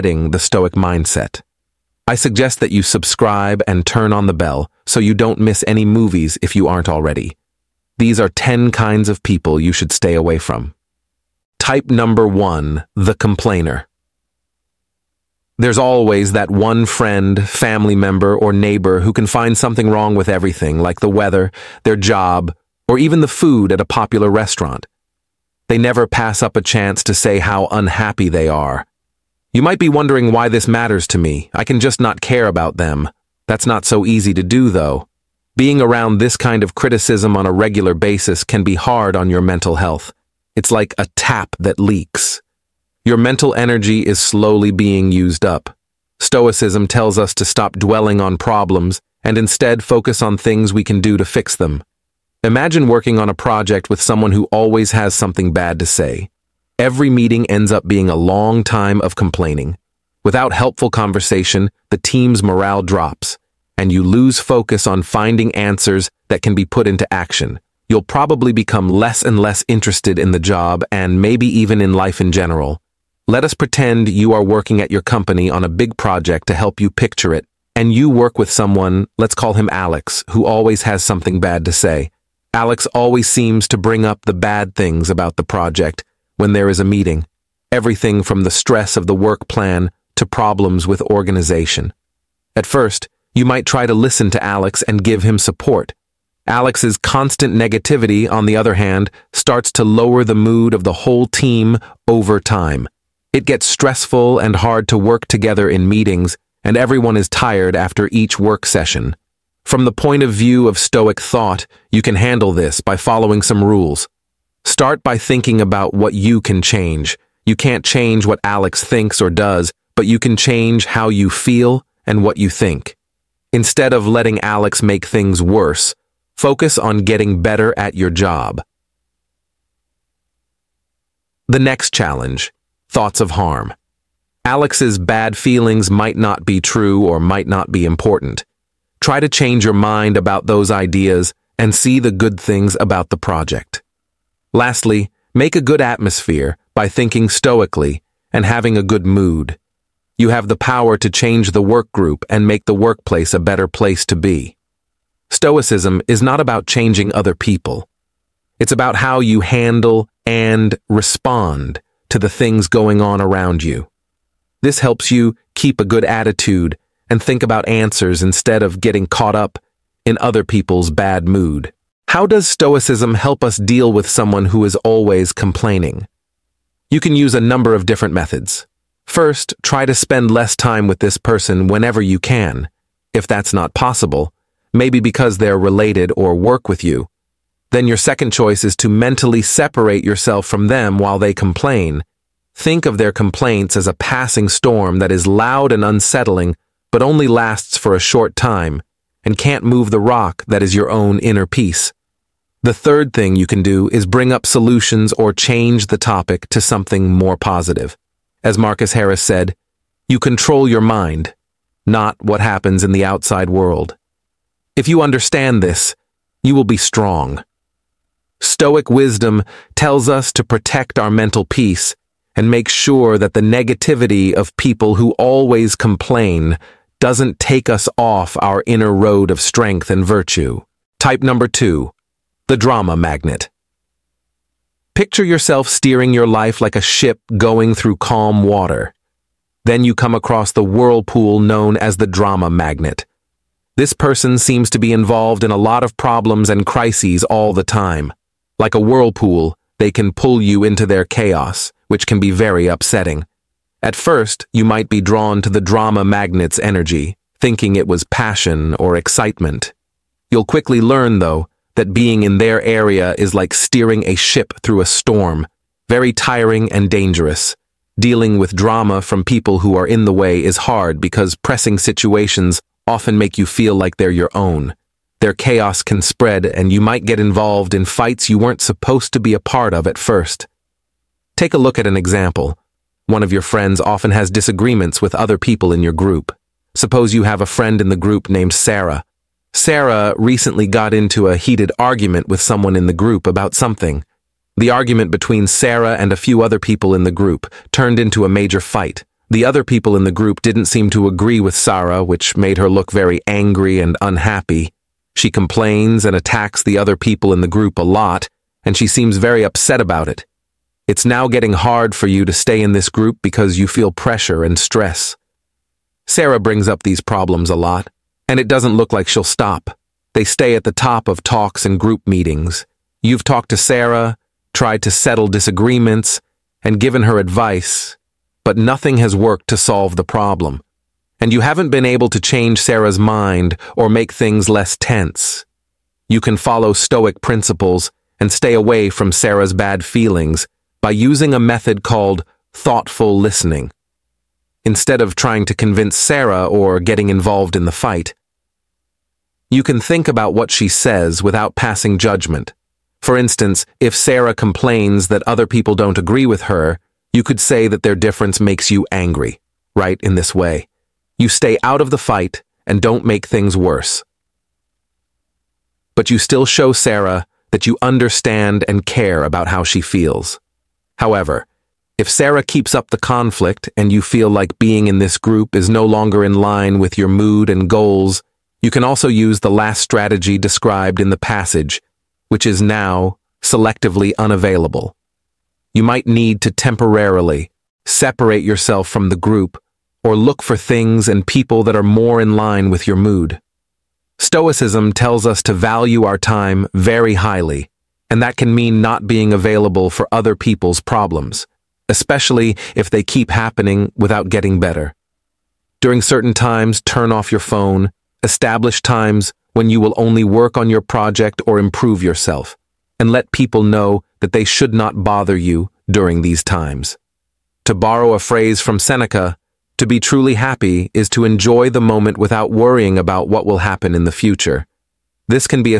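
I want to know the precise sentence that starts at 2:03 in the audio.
Instead of letting Alex make things worse, focus on getting better at your job.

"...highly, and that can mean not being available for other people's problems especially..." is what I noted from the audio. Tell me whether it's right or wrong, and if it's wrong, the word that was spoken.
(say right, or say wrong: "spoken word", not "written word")
right.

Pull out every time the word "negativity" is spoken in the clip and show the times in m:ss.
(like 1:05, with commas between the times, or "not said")
1:37, 3:43.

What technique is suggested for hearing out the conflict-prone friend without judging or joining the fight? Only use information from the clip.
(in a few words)
Thoughtful listening.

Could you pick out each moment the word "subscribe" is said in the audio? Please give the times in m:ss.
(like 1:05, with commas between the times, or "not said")
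0:02.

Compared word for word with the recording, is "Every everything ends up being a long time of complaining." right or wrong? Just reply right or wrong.
wrong.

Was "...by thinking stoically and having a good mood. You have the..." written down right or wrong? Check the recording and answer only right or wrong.
right.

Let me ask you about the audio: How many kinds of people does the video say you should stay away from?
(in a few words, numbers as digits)
10.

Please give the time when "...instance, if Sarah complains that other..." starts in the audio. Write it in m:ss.
5:53.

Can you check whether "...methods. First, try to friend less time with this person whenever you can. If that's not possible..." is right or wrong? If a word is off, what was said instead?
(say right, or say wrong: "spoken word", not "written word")
wrong: "spend", not "friend".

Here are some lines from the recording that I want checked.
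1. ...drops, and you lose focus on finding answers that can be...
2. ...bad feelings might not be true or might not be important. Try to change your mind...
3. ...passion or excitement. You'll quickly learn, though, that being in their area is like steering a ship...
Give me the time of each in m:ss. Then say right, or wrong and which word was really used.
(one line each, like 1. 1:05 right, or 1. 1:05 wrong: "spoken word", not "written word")
1. 1:02 right
2. 2:14 right
3. 4:18 right.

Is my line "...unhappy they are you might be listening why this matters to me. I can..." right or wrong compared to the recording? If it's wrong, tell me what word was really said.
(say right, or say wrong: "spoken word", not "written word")
wrong: "wondering", not "listening".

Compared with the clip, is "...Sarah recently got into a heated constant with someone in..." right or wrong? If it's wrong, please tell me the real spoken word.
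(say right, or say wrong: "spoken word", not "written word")
wrong: "argument", not "constant".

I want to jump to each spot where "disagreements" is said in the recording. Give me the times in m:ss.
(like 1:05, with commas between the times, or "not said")
4:44, 5:25.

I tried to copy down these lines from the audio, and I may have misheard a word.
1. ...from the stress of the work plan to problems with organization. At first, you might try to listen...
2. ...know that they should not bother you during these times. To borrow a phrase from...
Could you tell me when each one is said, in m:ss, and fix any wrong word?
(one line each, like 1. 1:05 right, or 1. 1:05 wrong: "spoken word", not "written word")
1. 1:28 right
2. 6:53 right.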